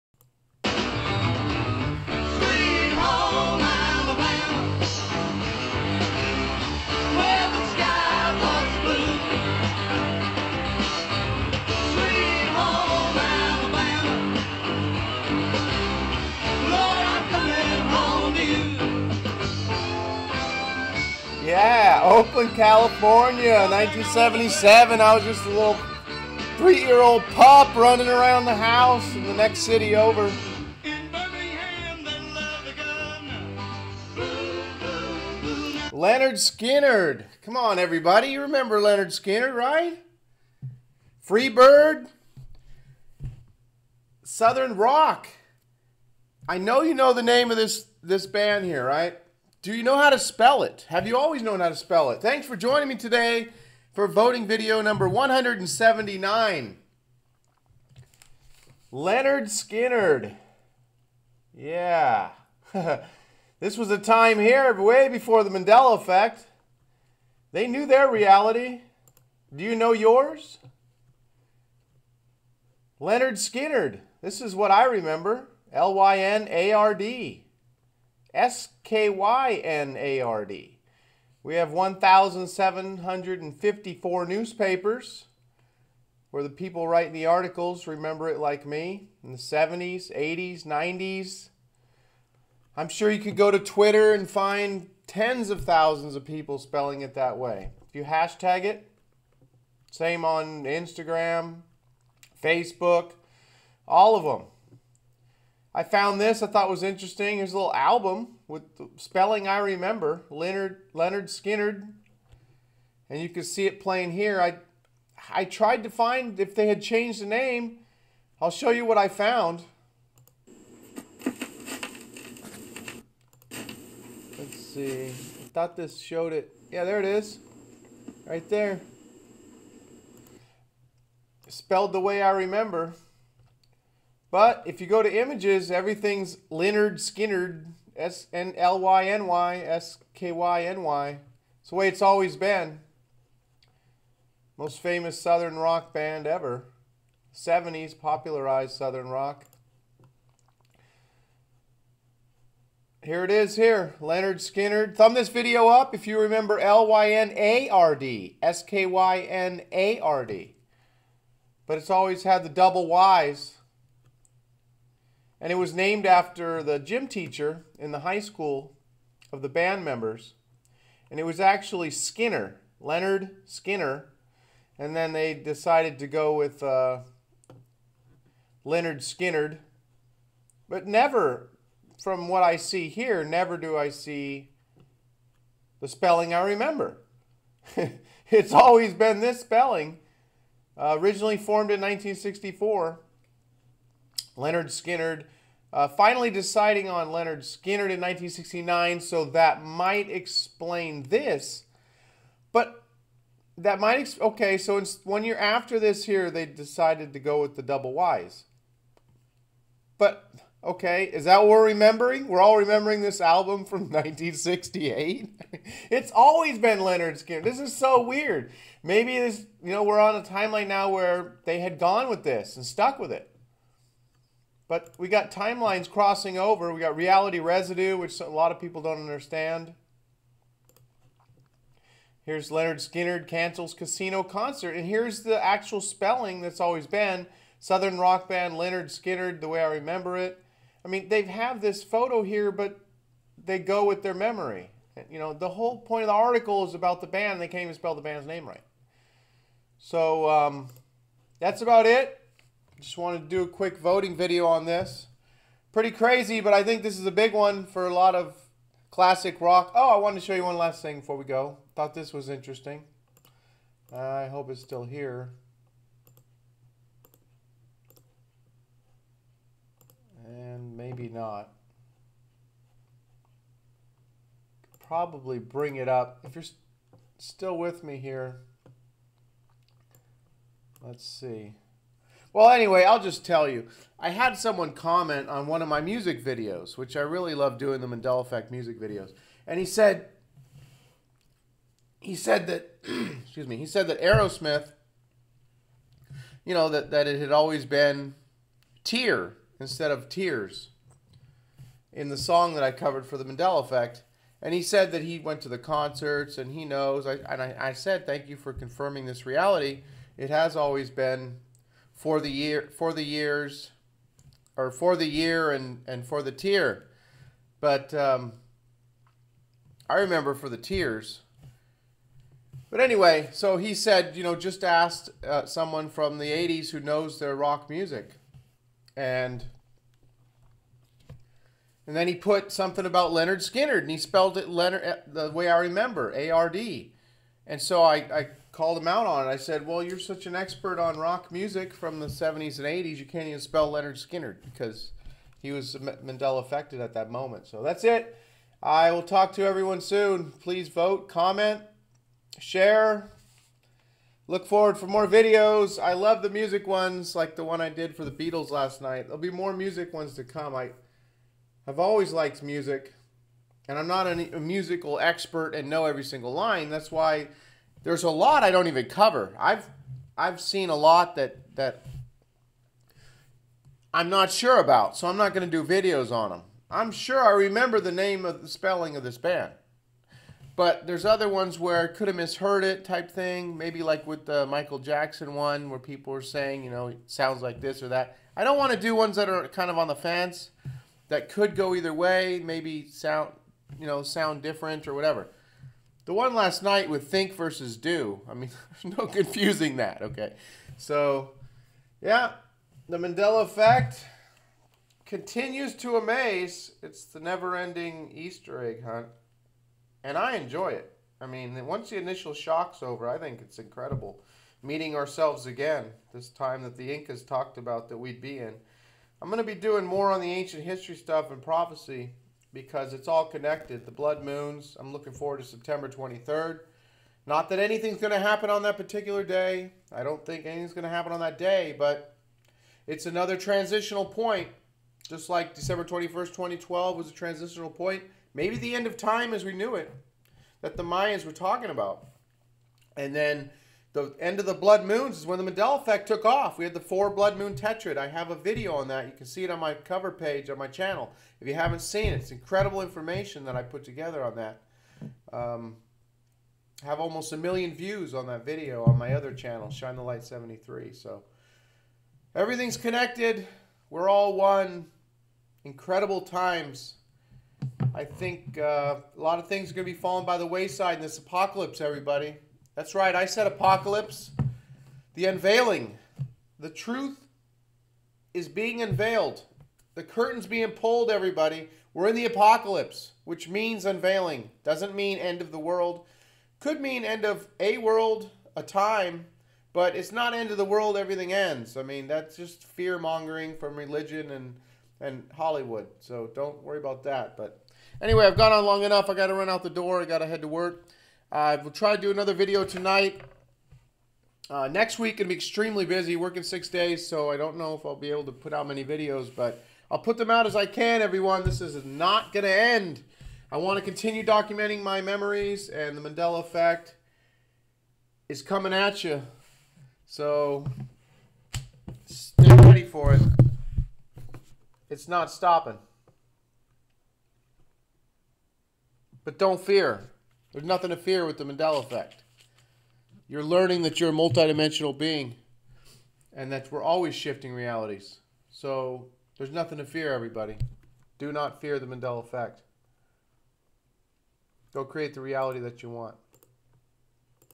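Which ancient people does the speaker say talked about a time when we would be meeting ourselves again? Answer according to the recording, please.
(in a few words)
Incas.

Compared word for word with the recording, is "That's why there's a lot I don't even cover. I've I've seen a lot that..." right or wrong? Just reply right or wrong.
right.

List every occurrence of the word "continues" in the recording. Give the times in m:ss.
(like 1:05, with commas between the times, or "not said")
6:45, 8:33.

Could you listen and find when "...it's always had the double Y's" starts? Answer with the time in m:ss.
2:41.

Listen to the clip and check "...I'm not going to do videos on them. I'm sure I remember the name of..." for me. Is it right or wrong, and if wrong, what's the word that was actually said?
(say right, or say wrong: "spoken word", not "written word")
right.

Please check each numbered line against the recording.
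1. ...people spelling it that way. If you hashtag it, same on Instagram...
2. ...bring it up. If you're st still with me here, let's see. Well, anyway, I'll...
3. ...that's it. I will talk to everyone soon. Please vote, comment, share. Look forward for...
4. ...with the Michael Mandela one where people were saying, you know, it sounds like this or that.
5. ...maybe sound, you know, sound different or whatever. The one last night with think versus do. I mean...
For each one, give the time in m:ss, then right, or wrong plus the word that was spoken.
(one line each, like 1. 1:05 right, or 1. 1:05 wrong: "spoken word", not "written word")
1. 1:36 right
2. 4:35 right
3. 5:47 right
4. 6:24 wrong: "Jackson", not "Mandela"
5. 6:32 right.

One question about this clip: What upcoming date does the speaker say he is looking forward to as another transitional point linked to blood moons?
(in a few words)
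September 23rd.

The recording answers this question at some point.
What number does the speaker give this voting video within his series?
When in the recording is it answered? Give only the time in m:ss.
0:55.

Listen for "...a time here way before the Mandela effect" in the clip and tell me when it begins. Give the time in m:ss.
1:03.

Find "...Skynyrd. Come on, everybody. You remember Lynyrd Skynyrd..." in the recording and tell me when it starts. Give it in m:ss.
0:36.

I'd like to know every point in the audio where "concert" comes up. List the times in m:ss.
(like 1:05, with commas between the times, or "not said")
3:54, 5:05.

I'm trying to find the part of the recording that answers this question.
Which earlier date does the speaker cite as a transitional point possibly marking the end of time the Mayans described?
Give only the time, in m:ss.
7:15.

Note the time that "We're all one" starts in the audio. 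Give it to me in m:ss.
7:43.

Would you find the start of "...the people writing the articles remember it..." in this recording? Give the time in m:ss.
1:26.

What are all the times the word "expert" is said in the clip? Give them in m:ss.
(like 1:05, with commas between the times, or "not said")
5:40, 6:04.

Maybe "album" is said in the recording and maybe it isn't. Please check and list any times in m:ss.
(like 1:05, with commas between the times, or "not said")
1:47, 3:33.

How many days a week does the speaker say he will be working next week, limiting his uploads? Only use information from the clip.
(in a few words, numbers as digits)
6.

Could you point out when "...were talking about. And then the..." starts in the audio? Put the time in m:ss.
7:21.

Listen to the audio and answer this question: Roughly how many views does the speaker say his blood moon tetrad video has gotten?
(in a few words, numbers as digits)
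almost a million.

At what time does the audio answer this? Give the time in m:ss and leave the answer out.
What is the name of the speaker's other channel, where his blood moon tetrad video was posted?
7:39.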